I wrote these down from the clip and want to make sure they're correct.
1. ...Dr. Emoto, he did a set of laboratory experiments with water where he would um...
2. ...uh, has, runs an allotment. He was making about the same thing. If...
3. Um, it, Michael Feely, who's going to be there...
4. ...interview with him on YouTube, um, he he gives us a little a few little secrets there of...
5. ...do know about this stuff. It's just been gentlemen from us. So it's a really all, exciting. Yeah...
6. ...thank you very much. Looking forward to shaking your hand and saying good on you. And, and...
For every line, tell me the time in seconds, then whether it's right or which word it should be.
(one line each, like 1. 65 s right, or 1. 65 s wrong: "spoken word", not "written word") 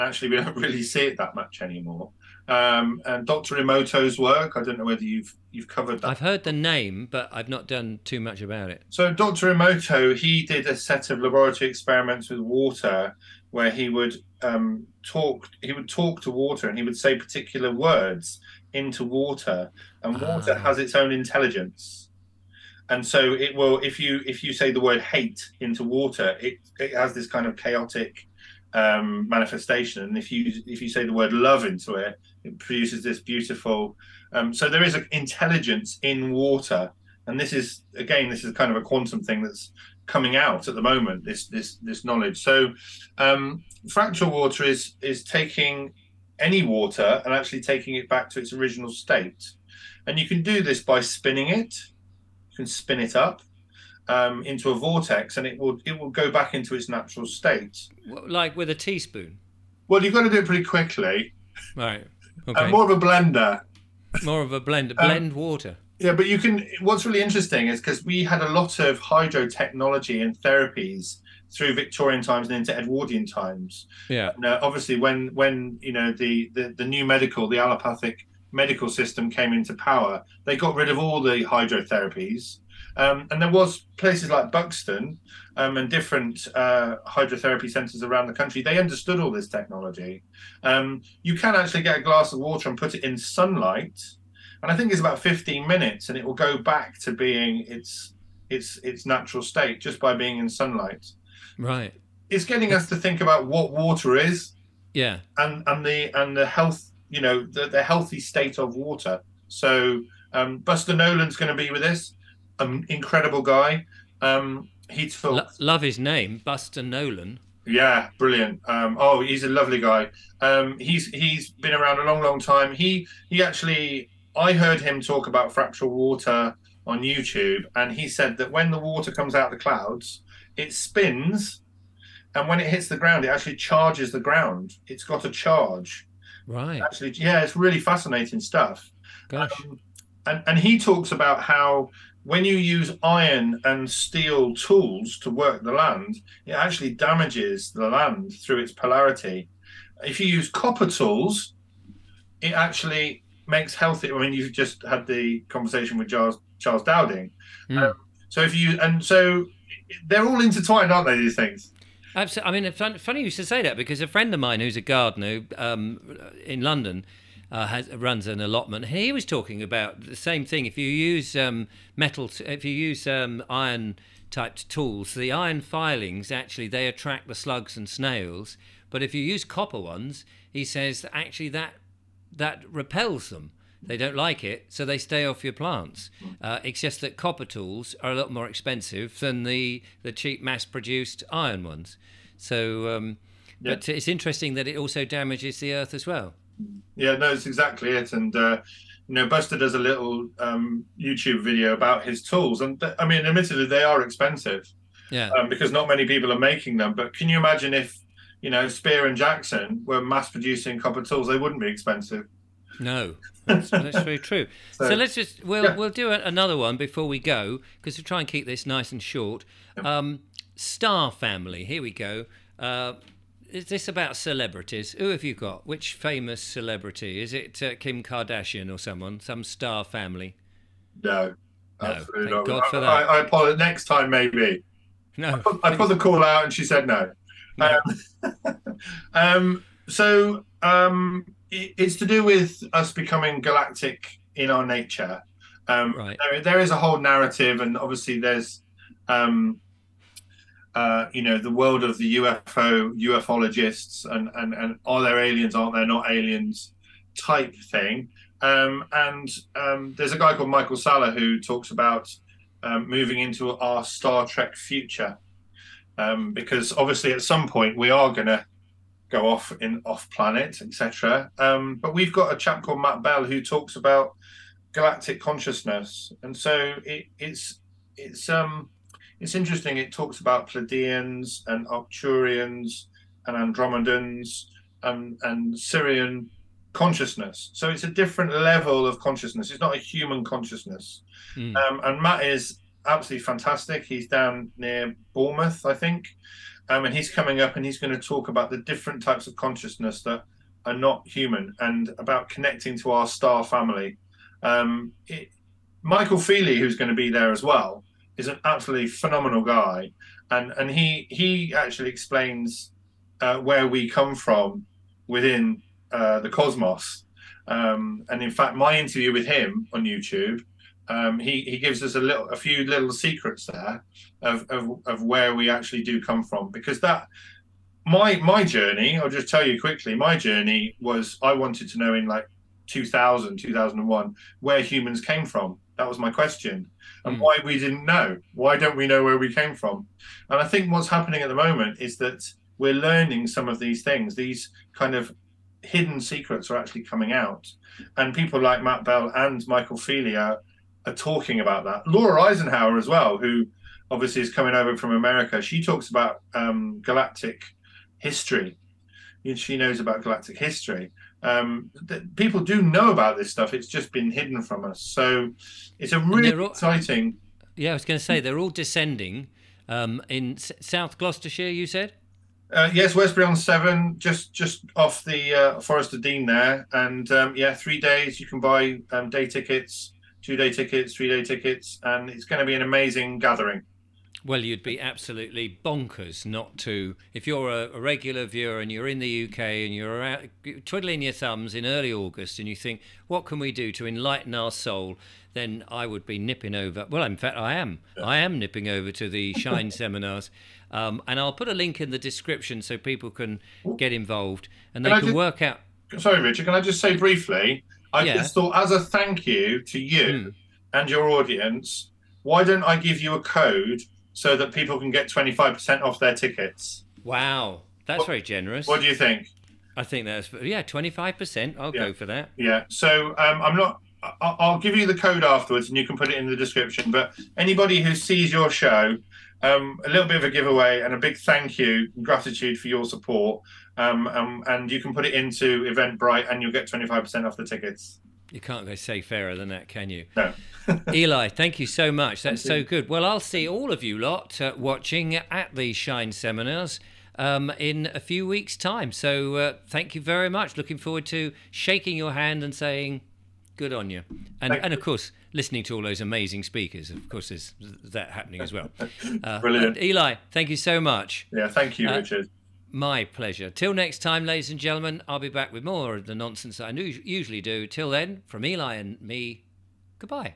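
1. 9 s right
2. 167 s wrong: "talking", not "making"
3. 304 s right
4. 318 s right
5. 362 s wrong: "hidden", not "gentlemen"
6. 449 s right.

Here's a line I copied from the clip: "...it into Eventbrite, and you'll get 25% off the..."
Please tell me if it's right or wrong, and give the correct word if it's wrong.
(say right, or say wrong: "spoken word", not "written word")
right.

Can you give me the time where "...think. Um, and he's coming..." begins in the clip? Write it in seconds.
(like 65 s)
295 s.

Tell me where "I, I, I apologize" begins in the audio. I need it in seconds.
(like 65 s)
232 s.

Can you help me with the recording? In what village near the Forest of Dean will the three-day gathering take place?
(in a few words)
Westbury on Severn.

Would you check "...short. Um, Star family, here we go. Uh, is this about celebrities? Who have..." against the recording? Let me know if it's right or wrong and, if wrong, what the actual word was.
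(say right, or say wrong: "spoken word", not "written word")
right.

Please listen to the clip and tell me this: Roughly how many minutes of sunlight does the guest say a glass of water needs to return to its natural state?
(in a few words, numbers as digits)
15.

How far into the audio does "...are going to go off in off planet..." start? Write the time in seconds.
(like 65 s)
267 s.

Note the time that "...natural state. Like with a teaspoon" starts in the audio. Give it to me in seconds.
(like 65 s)
56 s.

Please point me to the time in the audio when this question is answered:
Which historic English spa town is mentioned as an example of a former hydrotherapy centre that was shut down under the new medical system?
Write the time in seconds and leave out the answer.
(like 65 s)
84 s.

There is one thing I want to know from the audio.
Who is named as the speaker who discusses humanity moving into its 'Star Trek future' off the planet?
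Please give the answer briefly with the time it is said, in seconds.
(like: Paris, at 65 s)
Michael Salla, at 260 s.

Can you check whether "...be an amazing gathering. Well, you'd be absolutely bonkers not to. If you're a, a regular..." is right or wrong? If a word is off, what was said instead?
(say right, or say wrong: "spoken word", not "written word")
right.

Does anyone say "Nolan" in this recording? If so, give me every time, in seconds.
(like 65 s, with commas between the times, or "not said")
110 s, 116 s.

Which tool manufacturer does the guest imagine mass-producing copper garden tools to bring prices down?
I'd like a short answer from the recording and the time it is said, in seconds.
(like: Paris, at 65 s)
Spear and Jackson, at 208 s.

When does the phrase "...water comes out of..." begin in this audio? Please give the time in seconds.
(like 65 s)
128 s.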